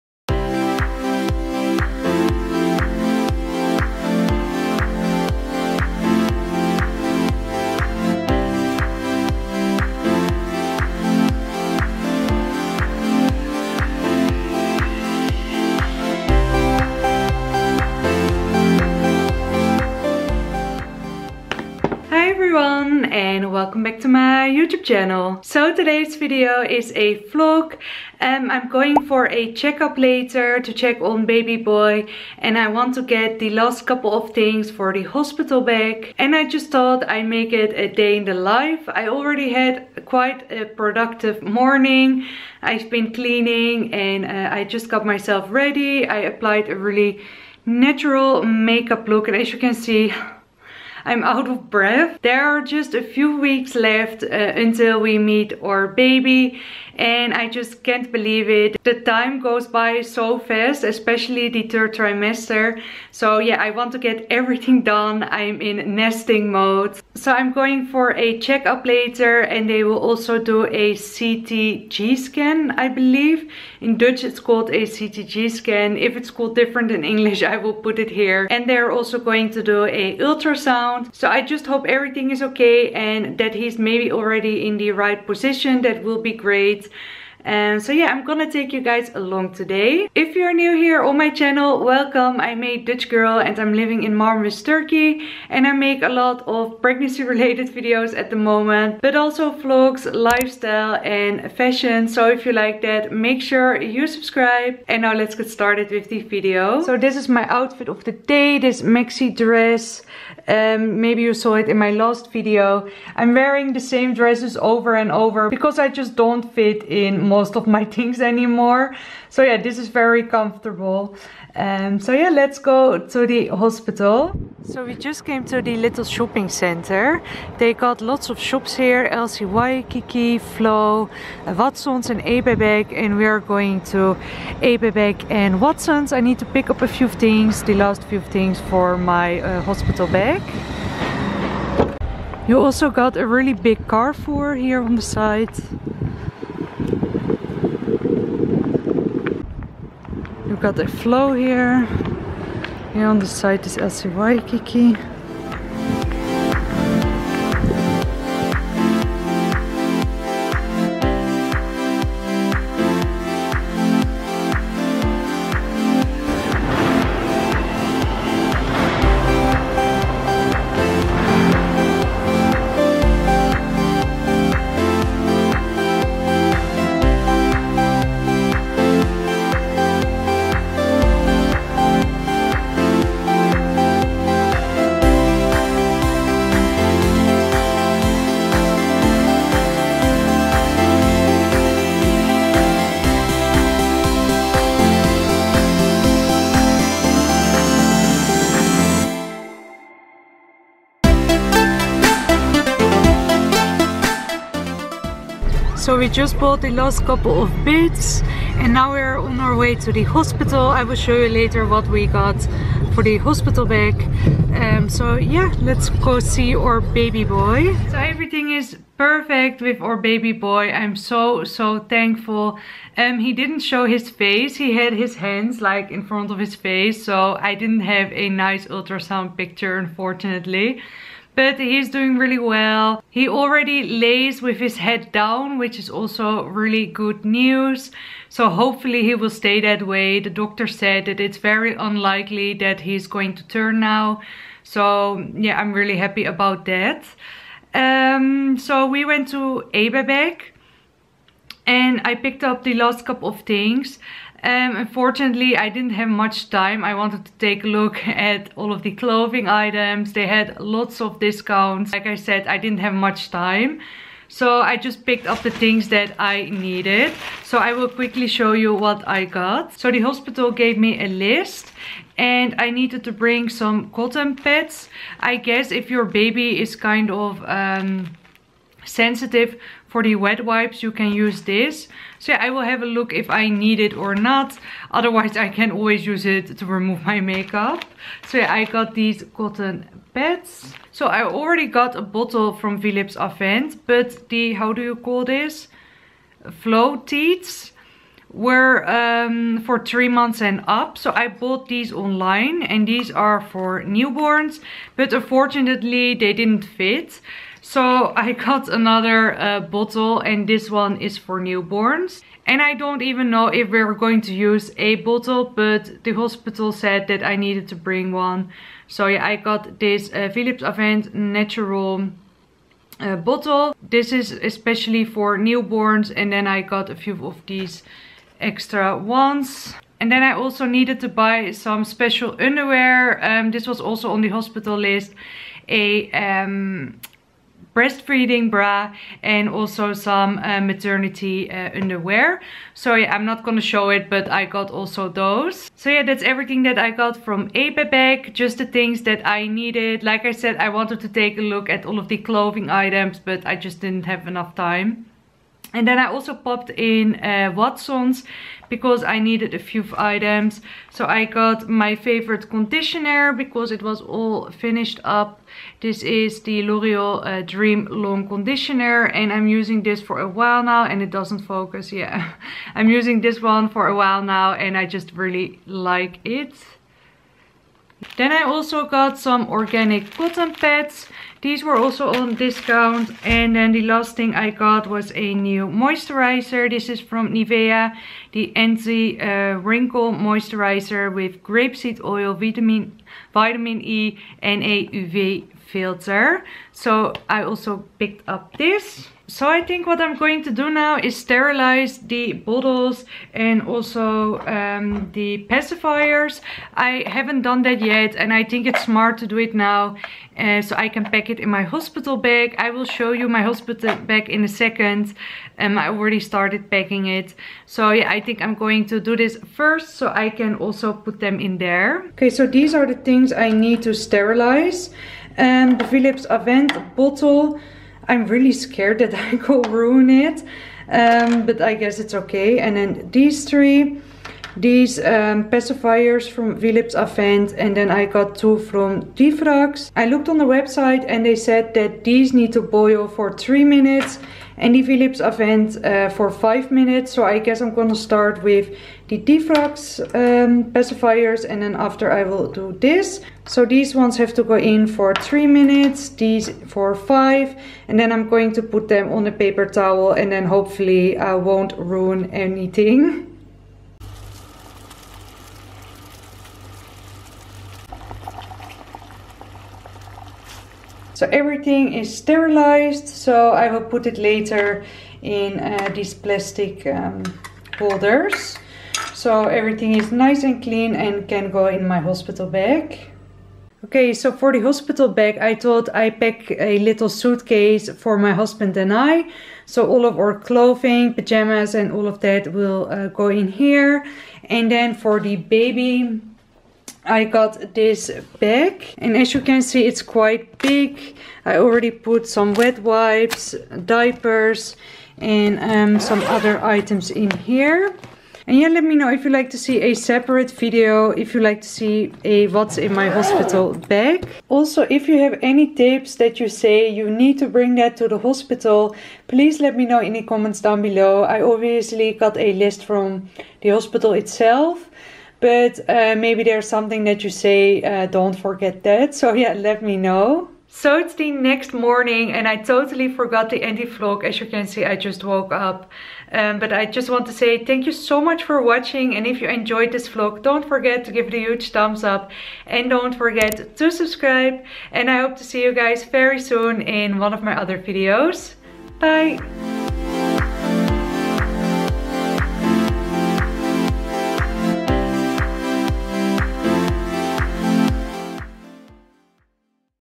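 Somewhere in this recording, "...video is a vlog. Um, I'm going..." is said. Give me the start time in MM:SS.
00:26.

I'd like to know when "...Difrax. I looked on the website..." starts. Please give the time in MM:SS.
07:19.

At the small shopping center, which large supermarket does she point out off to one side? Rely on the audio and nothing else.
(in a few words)
Carrefour.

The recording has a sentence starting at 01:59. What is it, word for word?
So yeah, this is very comfortable.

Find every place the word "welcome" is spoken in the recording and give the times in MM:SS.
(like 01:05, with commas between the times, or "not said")
00:23, 01:31.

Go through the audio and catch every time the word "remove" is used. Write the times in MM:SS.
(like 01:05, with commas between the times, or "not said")
04:46.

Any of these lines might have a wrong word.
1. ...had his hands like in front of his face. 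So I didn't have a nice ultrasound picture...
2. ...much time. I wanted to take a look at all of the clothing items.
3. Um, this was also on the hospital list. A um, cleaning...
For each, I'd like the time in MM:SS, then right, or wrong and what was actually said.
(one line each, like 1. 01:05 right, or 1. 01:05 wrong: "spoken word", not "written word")
1. 03:44 right
2. 04:16 right
3. 05:33 wrong: "breastfeeding", not "cleaning".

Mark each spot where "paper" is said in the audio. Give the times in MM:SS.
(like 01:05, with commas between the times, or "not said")
07:39.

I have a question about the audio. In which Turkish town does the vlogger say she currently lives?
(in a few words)
Marmaris.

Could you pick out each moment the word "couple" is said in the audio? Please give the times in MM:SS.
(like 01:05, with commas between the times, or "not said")
00:33, 03:27, 04:13.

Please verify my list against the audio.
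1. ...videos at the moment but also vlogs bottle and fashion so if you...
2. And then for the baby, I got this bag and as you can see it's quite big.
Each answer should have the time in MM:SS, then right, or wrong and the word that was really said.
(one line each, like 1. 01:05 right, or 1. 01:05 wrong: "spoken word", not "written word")
1. 01:37 wrong: "lifestyle", not "bottle"
2. 08:14 right.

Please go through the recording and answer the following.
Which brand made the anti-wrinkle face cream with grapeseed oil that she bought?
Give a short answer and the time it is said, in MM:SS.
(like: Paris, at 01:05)
Nivea, at 06:27.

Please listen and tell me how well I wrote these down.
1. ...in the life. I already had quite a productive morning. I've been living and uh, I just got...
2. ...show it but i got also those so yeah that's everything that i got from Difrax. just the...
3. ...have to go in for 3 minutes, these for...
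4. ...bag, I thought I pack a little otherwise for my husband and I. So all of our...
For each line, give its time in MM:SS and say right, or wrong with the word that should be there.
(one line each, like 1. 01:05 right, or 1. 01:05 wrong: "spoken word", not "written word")
1. 00:38 wrong: "cleaning", not "living"
2. 05:43 wrong: "Ebebek", not "Difrax"
3. 07:34 right
4. 08:05 wrong: "suitcase", not "otherwise".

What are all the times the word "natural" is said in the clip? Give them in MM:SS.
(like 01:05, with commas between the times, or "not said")
00:47, 05:21.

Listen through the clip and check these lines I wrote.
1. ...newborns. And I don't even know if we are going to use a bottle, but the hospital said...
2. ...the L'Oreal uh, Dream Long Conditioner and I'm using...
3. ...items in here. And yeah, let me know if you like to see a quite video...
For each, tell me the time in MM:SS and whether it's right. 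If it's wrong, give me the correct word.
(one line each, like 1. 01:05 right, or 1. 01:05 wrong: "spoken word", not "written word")
1. 05:11 right
2. 06:06 right
3. 08:26 wrong: "separate", not "quite".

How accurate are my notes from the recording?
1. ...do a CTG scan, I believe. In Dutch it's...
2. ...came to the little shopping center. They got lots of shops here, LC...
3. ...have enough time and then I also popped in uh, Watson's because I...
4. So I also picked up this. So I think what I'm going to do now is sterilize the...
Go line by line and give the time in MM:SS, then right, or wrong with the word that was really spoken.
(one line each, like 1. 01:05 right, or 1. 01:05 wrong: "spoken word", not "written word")
1. 01:10 right
2. 02:05 right
3. 05:54 right
4. 06:36 right.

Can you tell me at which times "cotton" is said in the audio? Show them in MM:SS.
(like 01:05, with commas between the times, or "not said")
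04:33, 04:49, 06:20.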